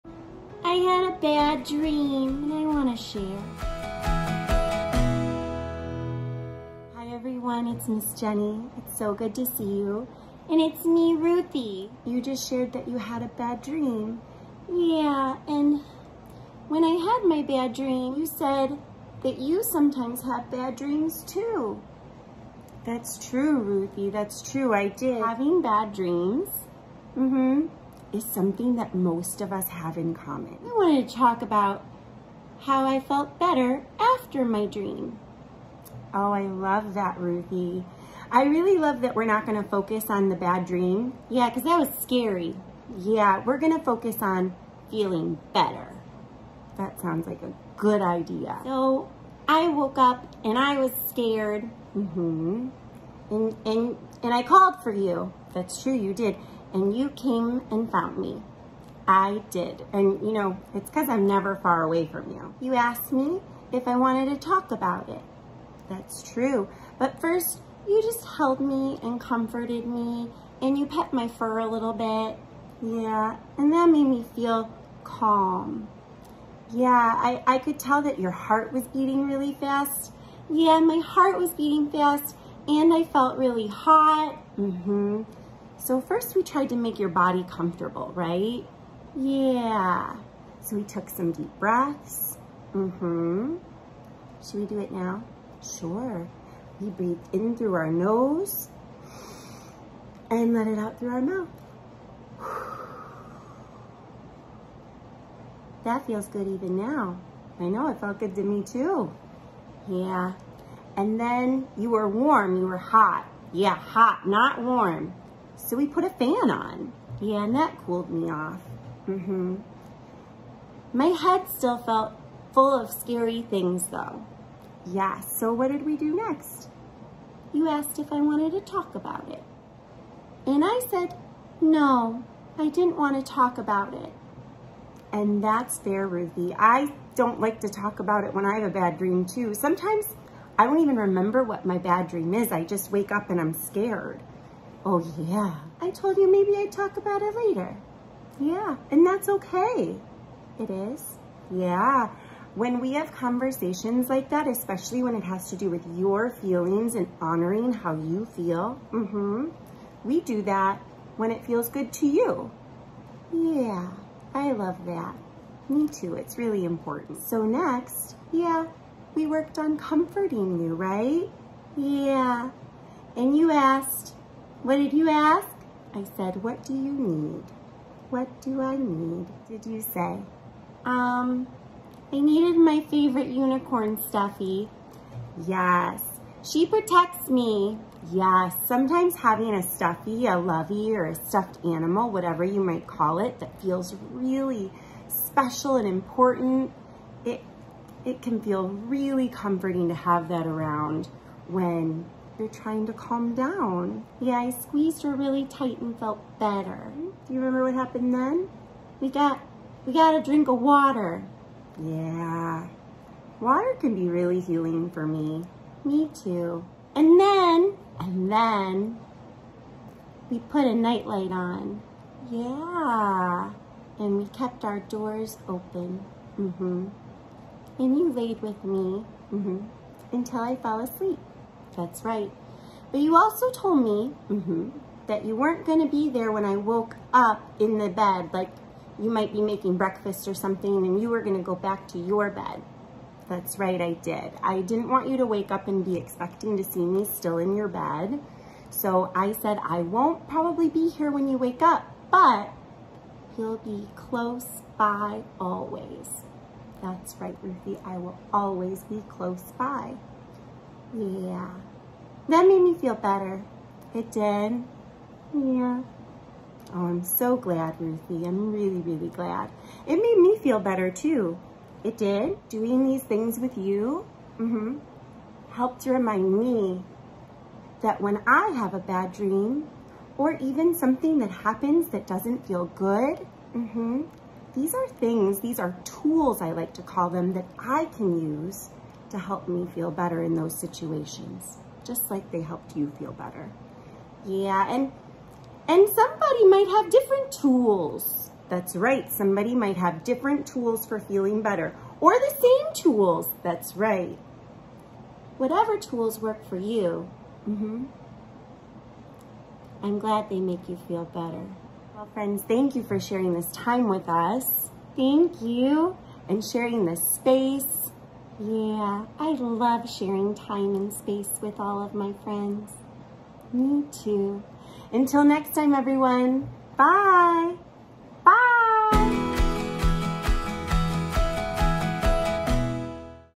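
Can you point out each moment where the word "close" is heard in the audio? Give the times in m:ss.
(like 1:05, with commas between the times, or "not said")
4:13, 4:19.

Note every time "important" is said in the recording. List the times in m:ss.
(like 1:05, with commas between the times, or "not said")
2:46, 3:15.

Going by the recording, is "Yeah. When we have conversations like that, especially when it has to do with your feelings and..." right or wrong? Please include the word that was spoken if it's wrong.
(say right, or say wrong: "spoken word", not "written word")
right.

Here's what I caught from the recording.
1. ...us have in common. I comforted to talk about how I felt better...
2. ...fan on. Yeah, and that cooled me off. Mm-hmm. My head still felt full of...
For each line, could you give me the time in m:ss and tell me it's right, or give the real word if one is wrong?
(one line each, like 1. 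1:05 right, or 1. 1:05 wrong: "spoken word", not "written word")
1. 0:29 wrong: "wanted", not "comforted"
2. 1:56 right.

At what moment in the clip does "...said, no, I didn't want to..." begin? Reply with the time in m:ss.
2:10.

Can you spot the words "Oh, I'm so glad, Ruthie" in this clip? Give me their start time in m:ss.
4:26.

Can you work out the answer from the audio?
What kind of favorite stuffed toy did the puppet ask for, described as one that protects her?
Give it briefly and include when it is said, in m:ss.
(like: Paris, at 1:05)
Unicorn, at 3:03.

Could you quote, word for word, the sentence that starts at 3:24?
Yeah, I squeezed her really tight and felt better.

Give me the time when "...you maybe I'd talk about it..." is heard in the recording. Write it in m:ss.
2:26.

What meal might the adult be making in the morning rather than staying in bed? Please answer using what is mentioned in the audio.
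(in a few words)
Breakfast.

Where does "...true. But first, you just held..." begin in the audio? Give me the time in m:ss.
1:06.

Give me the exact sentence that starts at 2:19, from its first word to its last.
Sometimes I don't even remember what my bad dream is.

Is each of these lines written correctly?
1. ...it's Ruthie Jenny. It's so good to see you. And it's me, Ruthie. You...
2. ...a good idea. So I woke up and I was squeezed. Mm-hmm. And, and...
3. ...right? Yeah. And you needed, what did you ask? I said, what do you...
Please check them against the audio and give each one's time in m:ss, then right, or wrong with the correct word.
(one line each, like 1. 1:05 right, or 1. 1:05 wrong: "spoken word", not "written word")
1. 0:07 wrong: "Miss", not "Ruthie"
2. 0:47 wrong: "scared", not "squeezed"
3. 2:50 wrong: "asked", not "needed".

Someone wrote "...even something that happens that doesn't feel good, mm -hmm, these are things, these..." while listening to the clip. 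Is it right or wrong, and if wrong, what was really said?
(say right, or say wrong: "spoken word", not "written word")
right.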